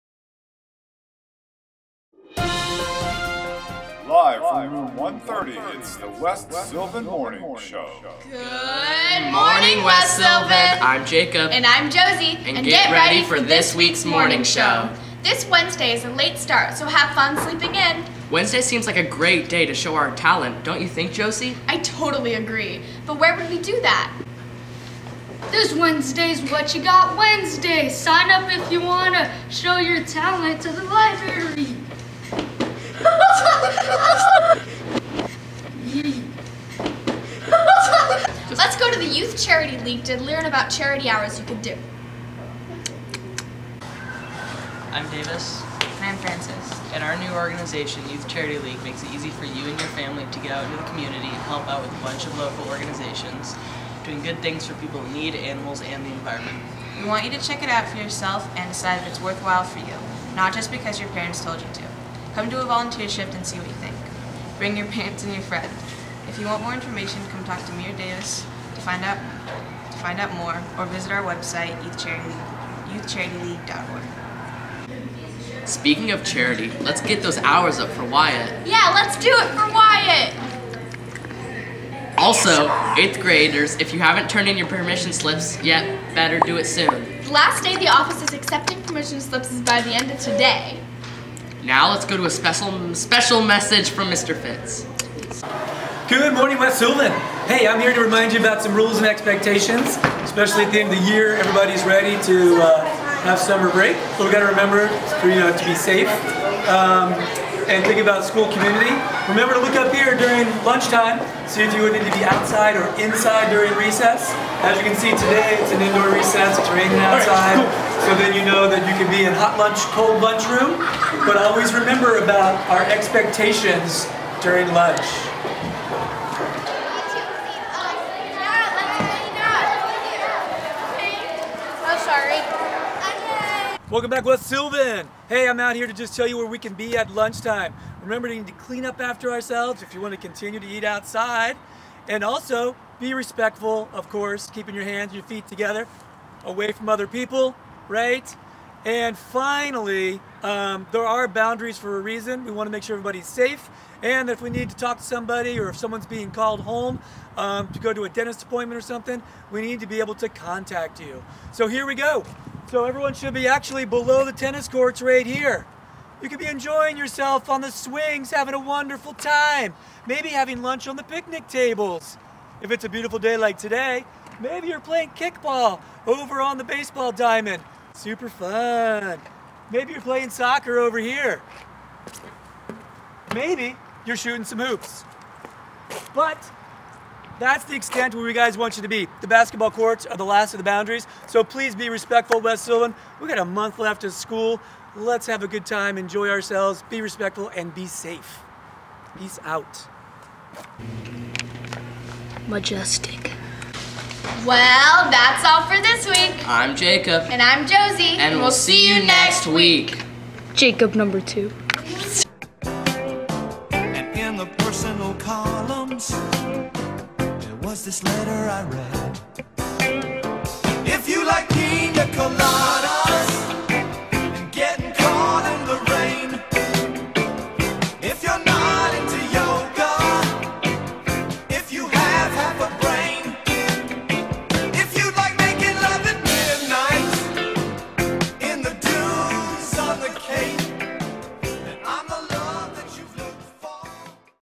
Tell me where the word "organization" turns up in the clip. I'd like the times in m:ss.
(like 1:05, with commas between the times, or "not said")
0:47, 0:52.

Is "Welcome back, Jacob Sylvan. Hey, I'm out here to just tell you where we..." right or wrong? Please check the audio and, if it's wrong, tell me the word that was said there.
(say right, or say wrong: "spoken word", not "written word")
wrong: "West", not "Jacob".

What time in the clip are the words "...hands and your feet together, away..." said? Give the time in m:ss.
2:24.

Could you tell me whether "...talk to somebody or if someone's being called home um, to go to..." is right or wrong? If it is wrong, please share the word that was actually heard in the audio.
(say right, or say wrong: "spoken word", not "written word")
right.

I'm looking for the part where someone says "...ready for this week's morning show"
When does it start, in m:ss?
0:13.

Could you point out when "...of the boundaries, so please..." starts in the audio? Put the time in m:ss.
3:10.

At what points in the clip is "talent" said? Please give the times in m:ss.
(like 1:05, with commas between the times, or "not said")
0:20, 0:30.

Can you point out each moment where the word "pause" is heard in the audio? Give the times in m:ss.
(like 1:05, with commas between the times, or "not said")
not said.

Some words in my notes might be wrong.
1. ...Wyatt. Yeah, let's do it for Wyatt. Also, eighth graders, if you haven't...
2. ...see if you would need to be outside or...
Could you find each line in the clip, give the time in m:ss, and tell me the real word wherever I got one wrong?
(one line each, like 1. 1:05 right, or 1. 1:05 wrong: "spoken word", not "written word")
1. 1:18 right
2. 1:51 right.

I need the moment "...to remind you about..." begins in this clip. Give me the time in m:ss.
1:37.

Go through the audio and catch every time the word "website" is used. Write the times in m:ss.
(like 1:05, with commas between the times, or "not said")
1:11.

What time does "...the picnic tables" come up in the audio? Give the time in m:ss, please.
2:50.